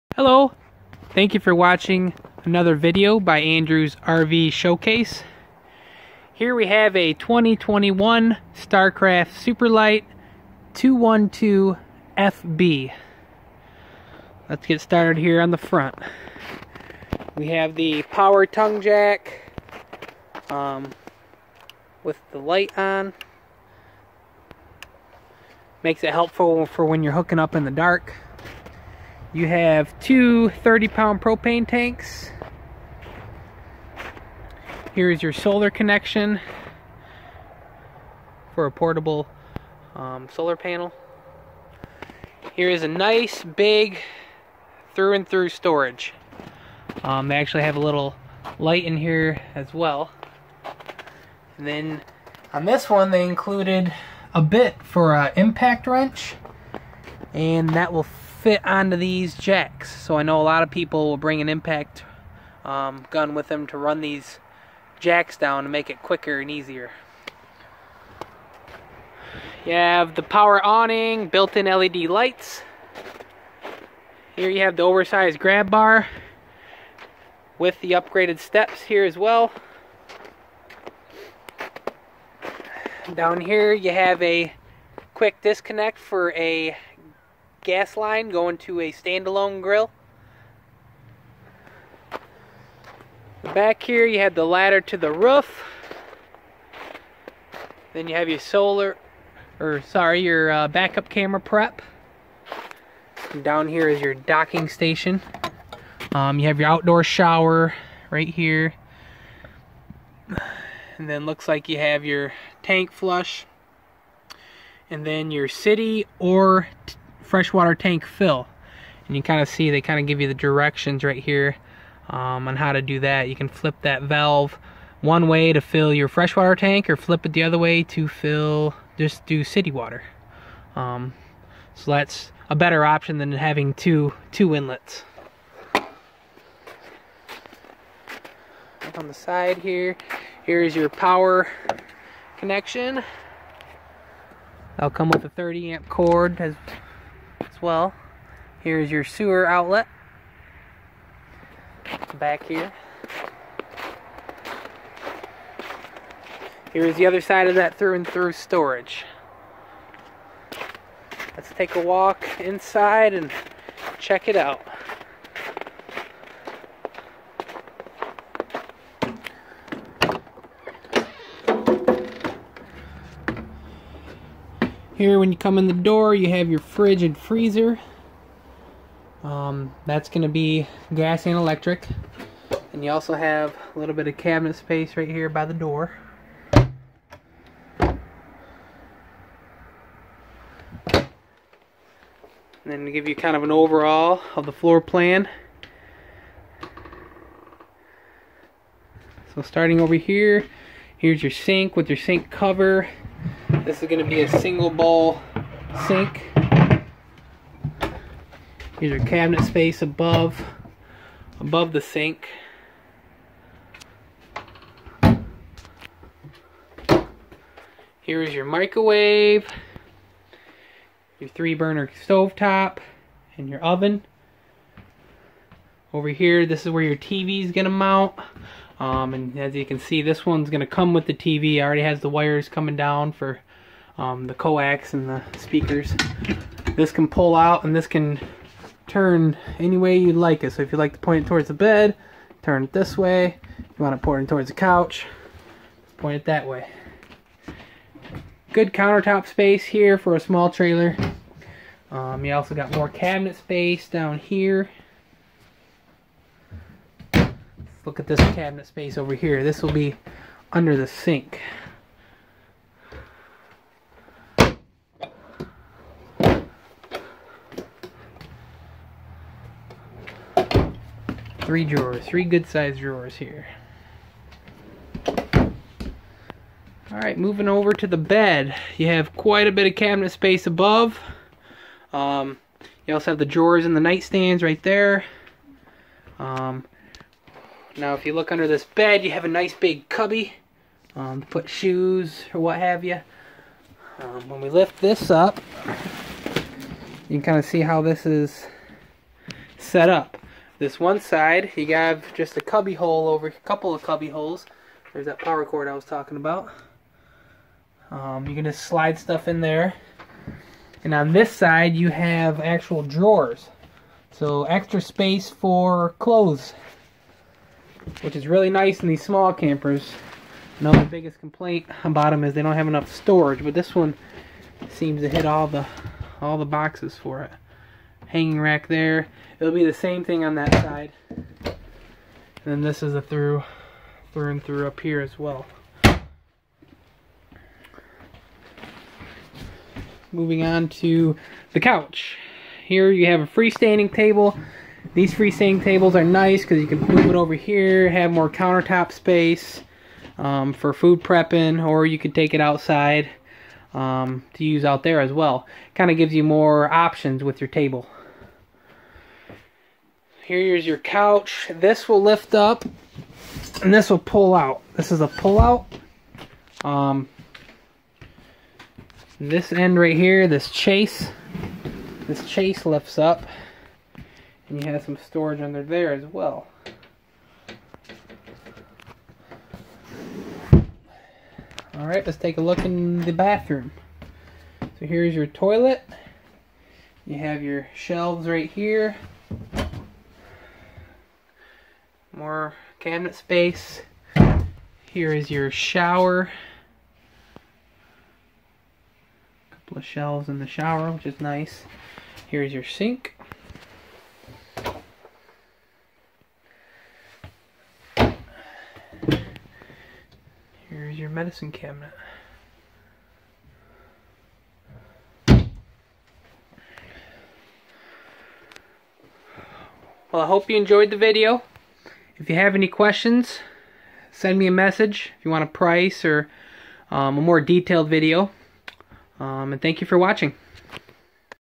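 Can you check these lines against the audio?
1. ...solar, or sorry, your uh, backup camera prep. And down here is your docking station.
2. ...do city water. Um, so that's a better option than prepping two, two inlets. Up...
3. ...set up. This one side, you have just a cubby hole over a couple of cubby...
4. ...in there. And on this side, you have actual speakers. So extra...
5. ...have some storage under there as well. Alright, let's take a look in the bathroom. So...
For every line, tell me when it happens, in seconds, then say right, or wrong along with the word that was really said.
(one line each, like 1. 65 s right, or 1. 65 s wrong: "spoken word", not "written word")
1. 98 s right
2. 129 s wrong: "having", not "prepping"
3. 299 s right
4. 309 s wrong: "drawers", not "speakers"
5. 374 s right.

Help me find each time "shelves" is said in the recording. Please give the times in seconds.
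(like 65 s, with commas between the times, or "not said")
387 s, 399 s.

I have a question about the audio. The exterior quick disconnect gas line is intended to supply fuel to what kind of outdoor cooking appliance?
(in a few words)
Standalone grill.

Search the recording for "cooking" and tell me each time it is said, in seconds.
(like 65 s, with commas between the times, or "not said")
not said.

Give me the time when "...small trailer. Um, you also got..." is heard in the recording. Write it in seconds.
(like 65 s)
250 s.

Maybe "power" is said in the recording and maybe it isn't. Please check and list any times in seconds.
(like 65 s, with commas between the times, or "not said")
18 s, 70 s, 140 s, 305 s.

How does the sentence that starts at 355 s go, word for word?
Kind of gives you more options with your table.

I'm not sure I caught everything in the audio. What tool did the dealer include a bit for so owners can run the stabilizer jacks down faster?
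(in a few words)
Impact wrench.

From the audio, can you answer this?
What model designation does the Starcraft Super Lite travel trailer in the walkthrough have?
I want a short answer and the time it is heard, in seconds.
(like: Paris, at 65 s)
212FB, at 10 s.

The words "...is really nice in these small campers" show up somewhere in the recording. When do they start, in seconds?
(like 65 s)
318 s.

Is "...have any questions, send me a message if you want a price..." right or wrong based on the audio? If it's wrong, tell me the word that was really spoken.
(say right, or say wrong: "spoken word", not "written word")
right.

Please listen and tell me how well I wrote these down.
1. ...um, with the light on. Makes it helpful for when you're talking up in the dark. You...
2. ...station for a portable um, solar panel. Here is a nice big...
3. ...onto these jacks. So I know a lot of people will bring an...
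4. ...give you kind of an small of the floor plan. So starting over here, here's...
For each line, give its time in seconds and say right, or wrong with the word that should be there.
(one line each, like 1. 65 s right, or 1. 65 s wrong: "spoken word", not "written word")
1. 20 s wrong: "hooking", not "talking"
2. 35 s wrong: "connection", not "station"
3. 58 s right
4. 192 s wrong: "overall", not "small".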